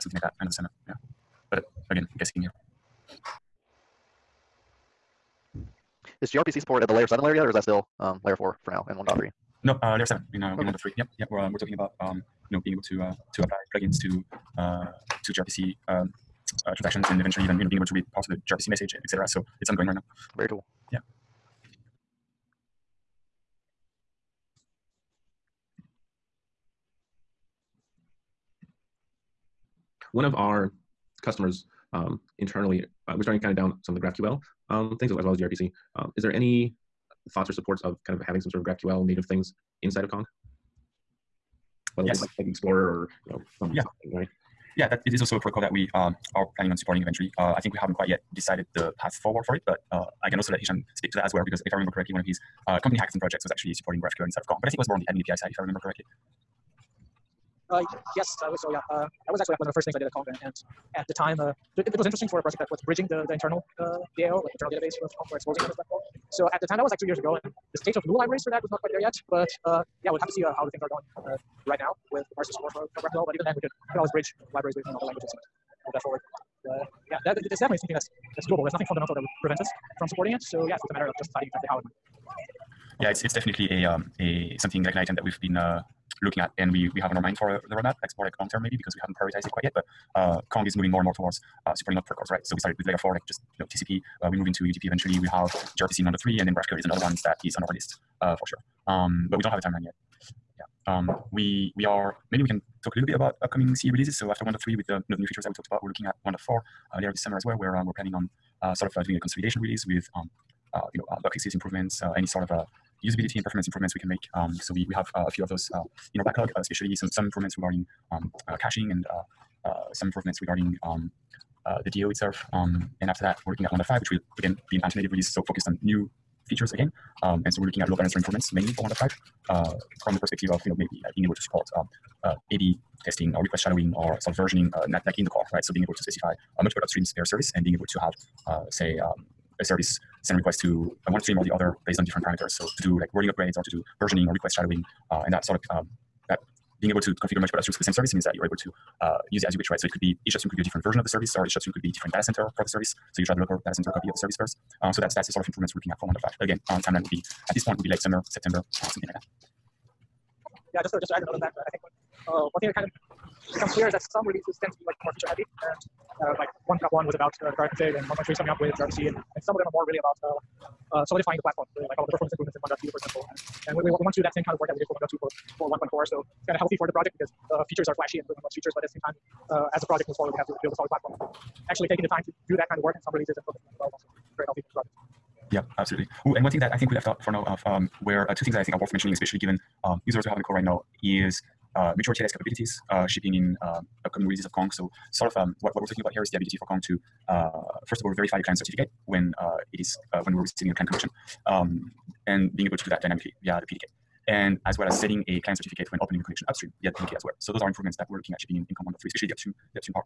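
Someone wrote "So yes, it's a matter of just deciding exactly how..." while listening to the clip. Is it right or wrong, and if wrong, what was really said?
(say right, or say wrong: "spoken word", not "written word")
right.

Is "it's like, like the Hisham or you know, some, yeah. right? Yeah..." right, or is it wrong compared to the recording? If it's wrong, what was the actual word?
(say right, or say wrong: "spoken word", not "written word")
wrong: "Explorer", not "Hisham".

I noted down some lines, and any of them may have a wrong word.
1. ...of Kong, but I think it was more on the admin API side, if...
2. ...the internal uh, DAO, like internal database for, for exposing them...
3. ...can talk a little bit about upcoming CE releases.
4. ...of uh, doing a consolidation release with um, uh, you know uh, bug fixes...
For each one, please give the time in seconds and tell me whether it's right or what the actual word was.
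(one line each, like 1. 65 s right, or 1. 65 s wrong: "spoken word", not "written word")
1. 54 s right
2. 63 s right
3. 102 s right
4. 108 s right.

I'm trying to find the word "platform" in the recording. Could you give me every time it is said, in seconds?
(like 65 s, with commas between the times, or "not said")
171 s, 180 s.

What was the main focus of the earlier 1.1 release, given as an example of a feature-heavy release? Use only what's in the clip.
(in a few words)
product config.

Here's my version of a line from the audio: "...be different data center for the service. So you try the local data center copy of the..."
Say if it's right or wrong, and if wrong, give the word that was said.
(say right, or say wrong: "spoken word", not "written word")
right.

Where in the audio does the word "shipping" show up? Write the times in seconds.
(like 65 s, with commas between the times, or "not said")
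193 s, 208 s.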